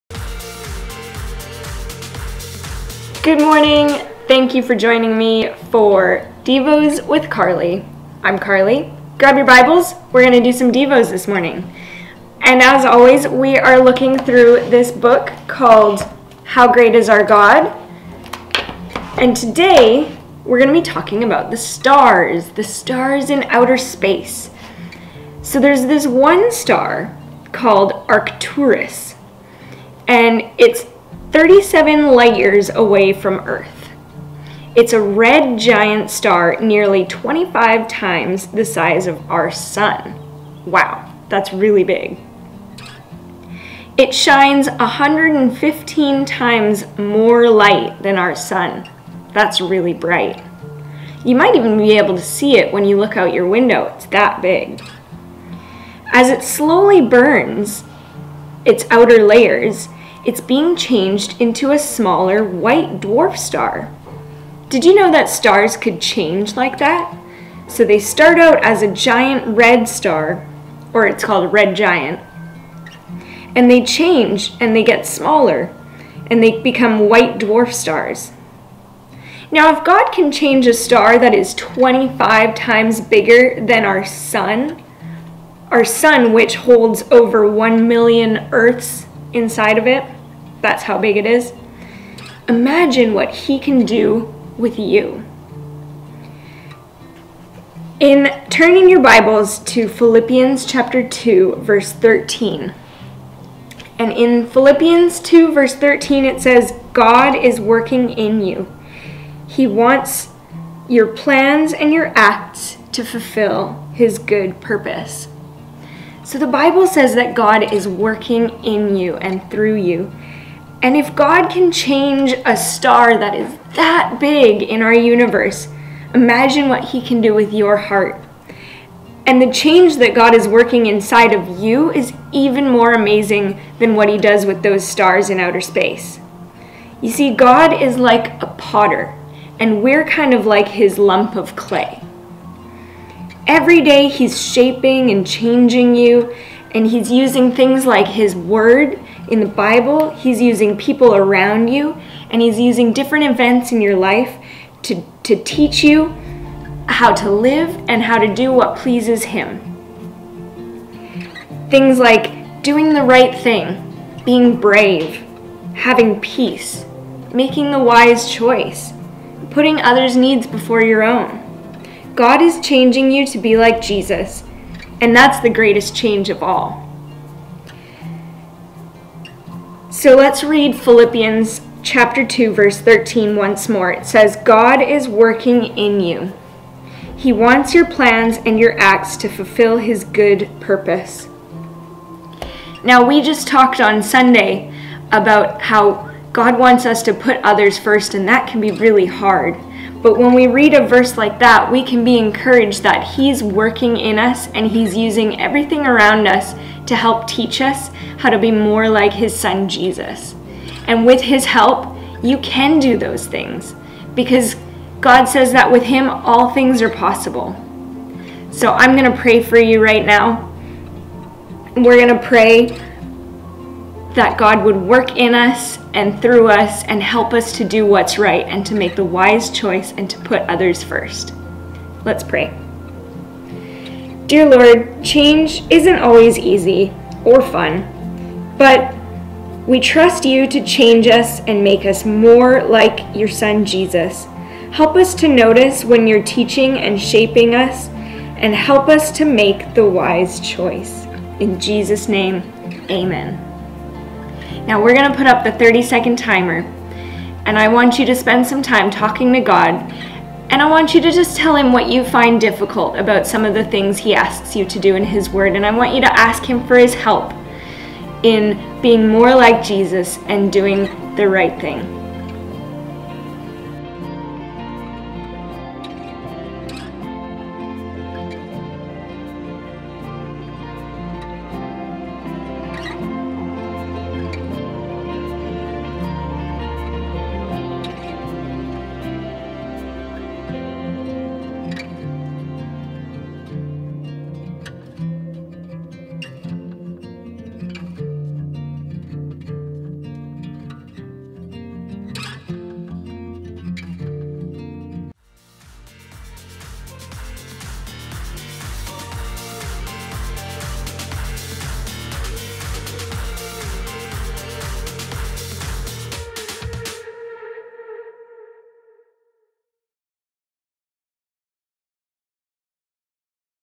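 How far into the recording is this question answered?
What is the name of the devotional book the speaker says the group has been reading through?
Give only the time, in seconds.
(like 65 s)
16 s.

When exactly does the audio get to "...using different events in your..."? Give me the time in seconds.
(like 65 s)
152 s.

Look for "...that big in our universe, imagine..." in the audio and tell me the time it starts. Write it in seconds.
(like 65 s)
123 s.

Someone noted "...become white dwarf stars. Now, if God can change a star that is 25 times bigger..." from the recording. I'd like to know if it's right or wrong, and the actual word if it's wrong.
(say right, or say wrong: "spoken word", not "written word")
right.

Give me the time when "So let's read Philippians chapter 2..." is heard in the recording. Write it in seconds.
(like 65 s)
179 s.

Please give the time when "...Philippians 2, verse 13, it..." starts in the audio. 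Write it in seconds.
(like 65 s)
104 s.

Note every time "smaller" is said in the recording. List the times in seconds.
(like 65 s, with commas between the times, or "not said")
61 s, 75 s.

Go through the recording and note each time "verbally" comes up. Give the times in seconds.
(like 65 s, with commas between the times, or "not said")
not said.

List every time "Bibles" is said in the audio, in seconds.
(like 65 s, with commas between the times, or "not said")
9 s, 98 s, 116 s, 149 s.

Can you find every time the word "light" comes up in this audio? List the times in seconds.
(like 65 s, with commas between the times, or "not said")
32 s, 47 s.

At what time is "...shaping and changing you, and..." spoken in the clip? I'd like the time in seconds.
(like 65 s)
144 s.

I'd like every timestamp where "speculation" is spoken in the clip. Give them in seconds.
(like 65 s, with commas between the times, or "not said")
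not said.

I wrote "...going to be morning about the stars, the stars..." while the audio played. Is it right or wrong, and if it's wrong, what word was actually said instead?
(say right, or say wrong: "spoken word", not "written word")
wrong: "talking", not "morning".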